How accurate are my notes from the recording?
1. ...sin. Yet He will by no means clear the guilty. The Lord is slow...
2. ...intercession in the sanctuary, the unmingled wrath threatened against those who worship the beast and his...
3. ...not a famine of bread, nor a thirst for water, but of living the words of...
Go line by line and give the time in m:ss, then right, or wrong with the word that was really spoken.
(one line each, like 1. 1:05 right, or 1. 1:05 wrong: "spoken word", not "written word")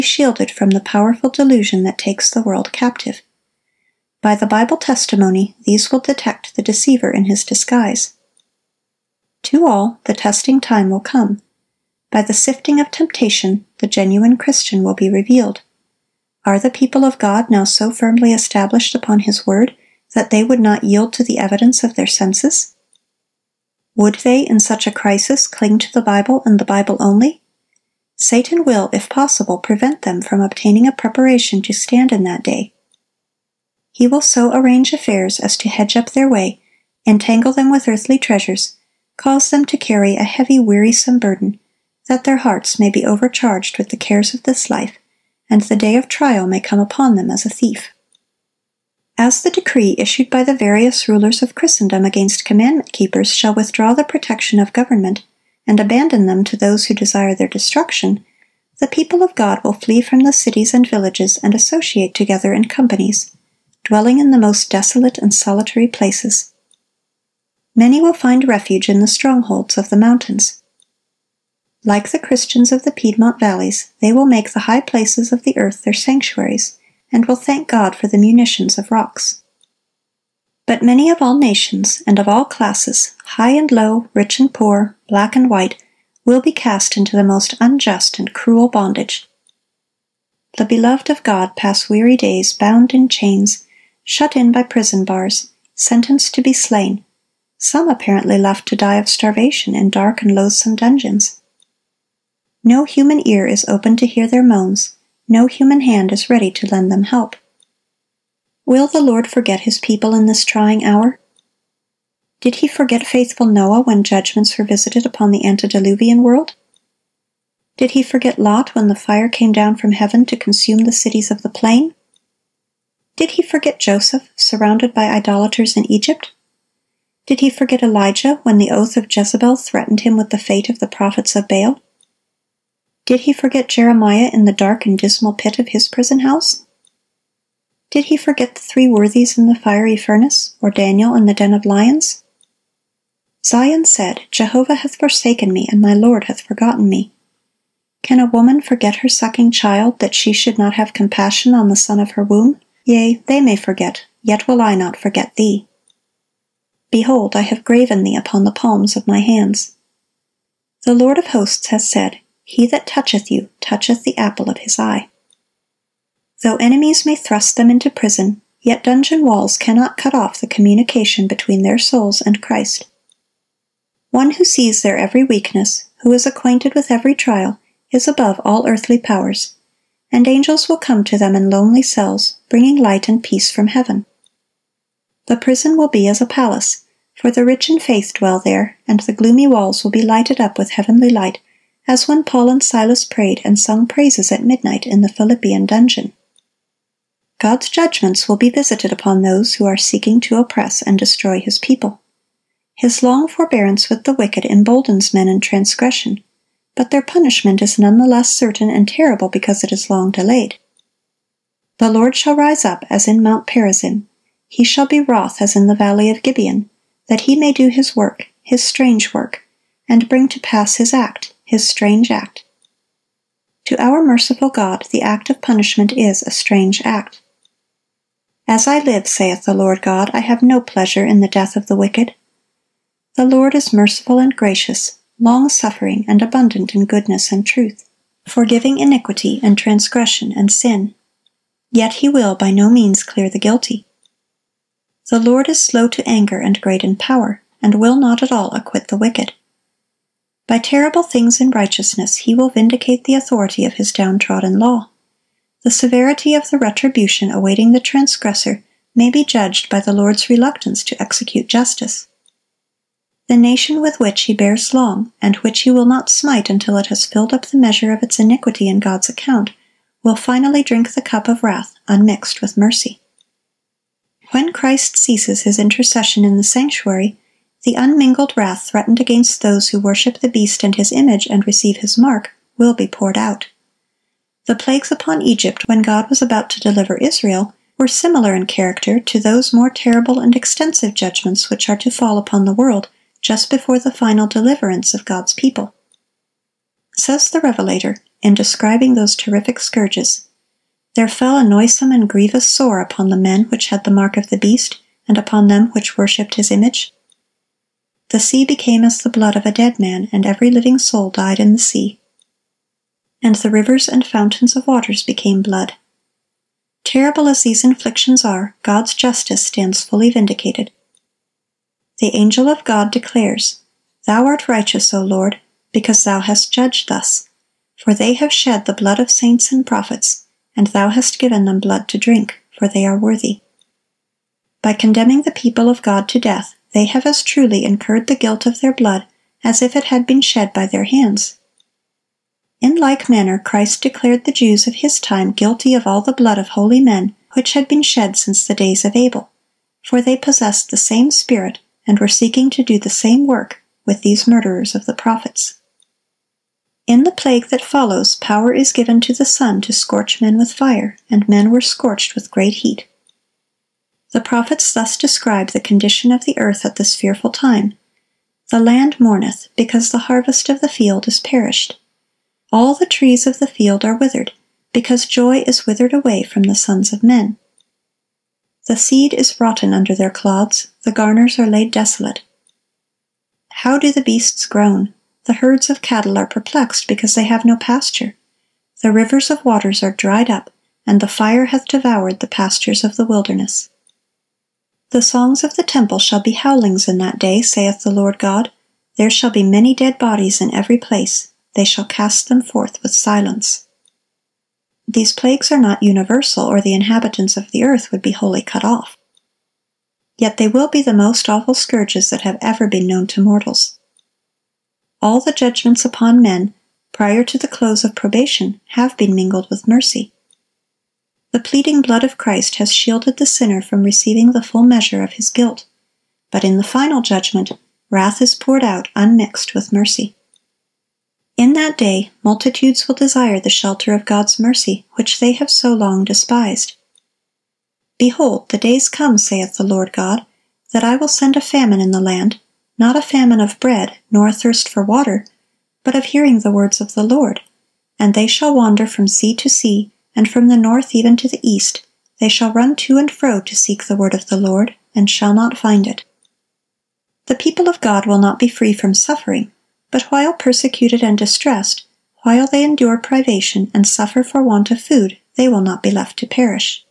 1. 4:00 right
2. 4:35 right
3. 7:22 wrong: "hearing", not "living".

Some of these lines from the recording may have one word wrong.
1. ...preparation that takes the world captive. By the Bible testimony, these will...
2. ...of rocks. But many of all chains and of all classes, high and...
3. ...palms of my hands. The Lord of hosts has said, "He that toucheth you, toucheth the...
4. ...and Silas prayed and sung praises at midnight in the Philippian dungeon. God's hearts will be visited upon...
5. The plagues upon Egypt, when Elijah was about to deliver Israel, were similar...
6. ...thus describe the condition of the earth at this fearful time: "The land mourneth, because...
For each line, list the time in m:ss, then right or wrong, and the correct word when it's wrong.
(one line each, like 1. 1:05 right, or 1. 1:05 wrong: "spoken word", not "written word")
1. 0:01 wrong: "delusion", not "preparation"
2. 1:18 wrong: "nations", not "chains"
3. 2:38 right
4. 3:12 wrong: "judgments", not "hearts"
5. 4:44 wrong: "God", not "Elijah"
6. 6:04 right.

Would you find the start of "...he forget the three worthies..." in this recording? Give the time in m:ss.
2:18.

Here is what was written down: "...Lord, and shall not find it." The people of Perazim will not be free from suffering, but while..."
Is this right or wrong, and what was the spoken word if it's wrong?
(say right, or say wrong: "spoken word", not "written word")
wrong: "God", not "Perazim".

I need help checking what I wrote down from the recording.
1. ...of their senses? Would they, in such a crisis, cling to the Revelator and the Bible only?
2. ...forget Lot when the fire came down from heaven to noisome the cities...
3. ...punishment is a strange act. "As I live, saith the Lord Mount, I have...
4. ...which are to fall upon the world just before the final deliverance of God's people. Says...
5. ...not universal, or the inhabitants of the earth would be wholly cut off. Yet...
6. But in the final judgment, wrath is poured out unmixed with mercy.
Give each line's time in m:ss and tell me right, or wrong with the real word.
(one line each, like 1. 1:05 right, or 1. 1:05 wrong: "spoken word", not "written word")
1. 0:21 wrong: "Bible", not "Revelator"
2. 1:58 wrong: "consume", not "noisome"
3. 3:45 wrong: "God", not "Mount"
4. 4:51 right
5. 6:45 right
6. 7:06 right.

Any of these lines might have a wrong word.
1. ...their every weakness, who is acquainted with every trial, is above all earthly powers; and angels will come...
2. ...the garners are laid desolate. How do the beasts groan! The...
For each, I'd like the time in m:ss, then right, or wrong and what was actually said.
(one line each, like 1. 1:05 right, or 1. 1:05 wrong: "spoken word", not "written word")
1. 2:54 right
2. 6:20 right.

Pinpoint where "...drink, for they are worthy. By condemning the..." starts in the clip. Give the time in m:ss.
5:31.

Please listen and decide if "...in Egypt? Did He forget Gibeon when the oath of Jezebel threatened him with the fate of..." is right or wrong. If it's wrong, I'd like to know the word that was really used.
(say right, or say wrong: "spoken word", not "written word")
wrong: "Elijah", not "Gibeon".